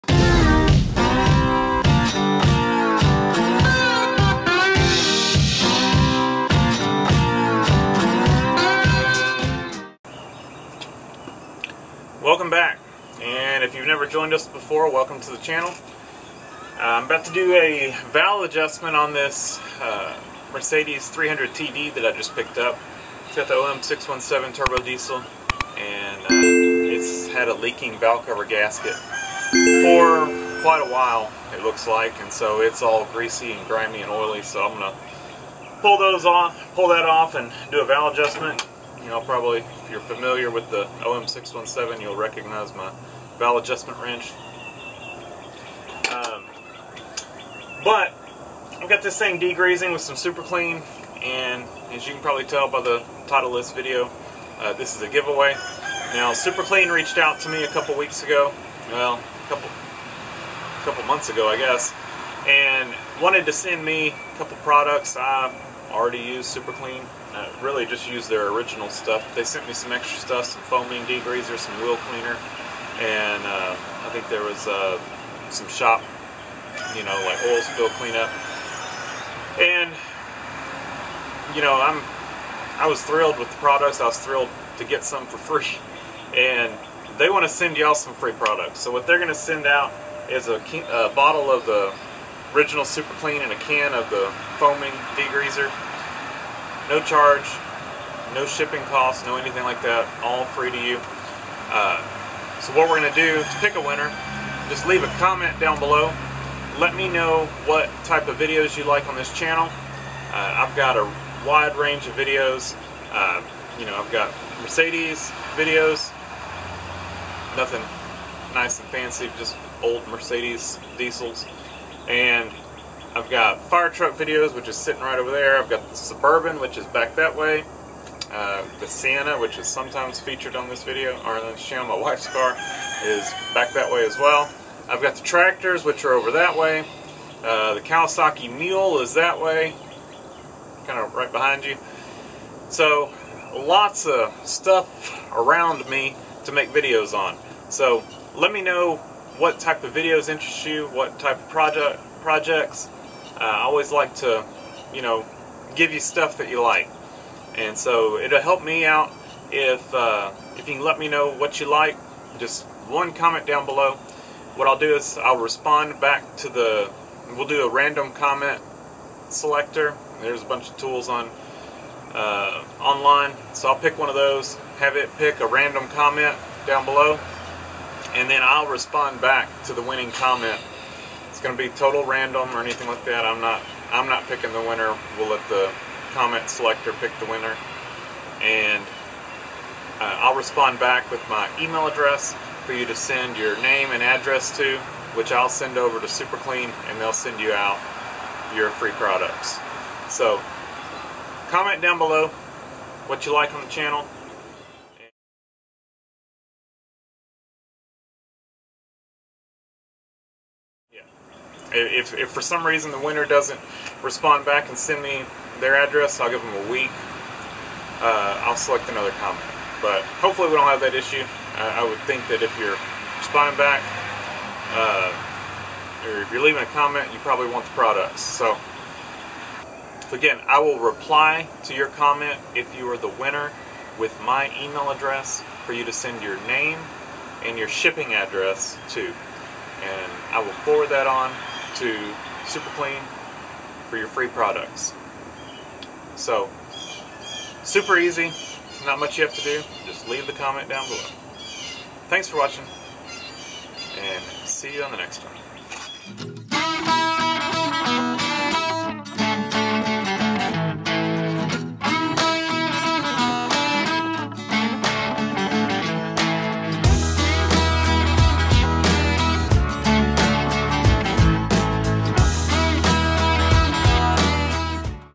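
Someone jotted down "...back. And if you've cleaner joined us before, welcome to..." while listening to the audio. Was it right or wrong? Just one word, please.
wrong.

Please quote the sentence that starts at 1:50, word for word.
Uh, I've got a wide range of videos.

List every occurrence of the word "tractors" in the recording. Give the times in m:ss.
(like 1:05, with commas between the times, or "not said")
2:15.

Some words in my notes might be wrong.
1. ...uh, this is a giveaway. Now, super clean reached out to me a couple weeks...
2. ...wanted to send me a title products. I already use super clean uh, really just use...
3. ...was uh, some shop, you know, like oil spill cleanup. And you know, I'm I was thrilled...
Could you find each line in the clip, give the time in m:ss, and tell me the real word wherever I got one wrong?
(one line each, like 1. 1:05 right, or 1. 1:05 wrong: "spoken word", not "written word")
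1. 0:54 right
2. 1:03 wrong: "couple", not "title"
3. 1:14 right.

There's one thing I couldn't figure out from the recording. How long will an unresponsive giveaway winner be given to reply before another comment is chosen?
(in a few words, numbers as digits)
a week.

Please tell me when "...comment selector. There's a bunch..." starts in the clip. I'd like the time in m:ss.
2:48.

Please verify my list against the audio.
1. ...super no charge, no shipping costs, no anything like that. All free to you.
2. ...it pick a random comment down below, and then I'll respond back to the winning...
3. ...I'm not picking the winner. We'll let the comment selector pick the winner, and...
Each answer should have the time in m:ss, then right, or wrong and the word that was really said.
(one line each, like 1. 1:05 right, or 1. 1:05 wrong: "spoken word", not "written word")
1. 1:35 wrong: "degreaser", not "super"
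2. 2:54 right
3. 3:03 right.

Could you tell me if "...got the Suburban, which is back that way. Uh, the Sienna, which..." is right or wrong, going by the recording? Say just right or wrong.
right.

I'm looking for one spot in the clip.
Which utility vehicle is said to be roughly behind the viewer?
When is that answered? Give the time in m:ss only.
2:17.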